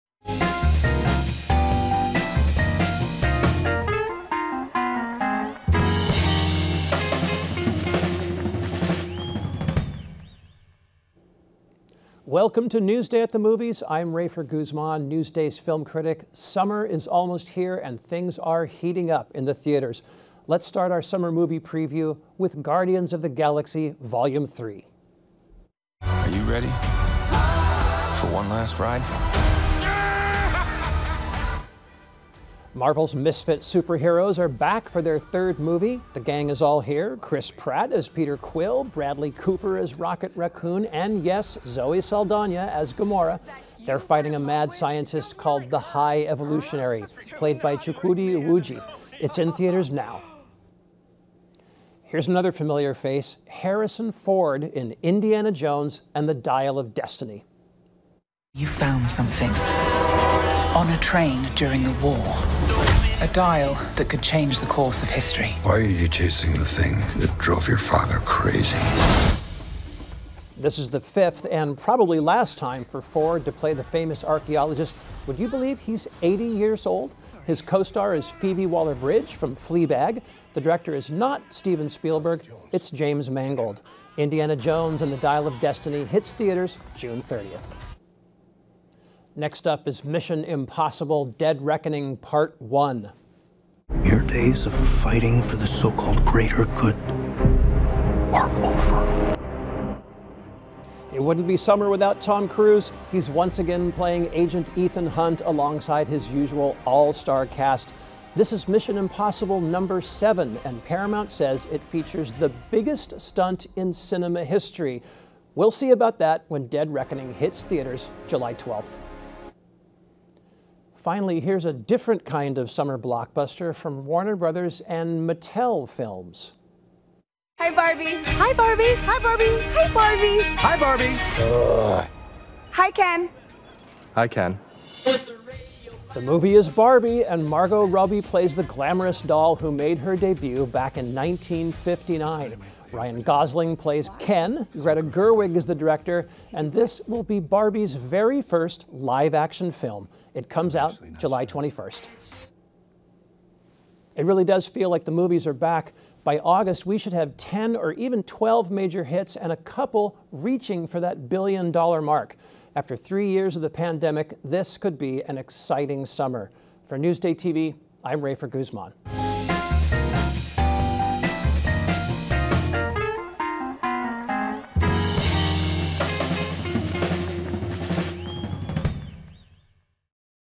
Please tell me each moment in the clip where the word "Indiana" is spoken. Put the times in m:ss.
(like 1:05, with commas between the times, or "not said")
0:55, 1:24.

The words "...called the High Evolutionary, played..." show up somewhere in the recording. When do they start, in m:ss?
0:45.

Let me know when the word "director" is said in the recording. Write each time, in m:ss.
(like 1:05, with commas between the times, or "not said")
1:20, 2:25.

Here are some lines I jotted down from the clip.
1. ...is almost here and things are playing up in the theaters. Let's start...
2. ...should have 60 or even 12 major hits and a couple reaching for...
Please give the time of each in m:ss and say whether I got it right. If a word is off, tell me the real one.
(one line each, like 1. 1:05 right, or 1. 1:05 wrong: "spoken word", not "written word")
1. 0:16 wrong: "heating", not "playing"
2. 2:36 wrong: "10", not "60".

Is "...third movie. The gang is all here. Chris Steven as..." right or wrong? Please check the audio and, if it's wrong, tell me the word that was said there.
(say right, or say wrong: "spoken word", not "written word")
wrong: "Pratt", not "Steven".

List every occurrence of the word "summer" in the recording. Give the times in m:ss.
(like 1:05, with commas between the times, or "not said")
0:16, 0:21, 1:41, 2:02, 2:46.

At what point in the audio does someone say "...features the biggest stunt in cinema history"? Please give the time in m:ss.
1:51.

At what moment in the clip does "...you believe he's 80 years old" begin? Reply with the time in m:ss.
1:15.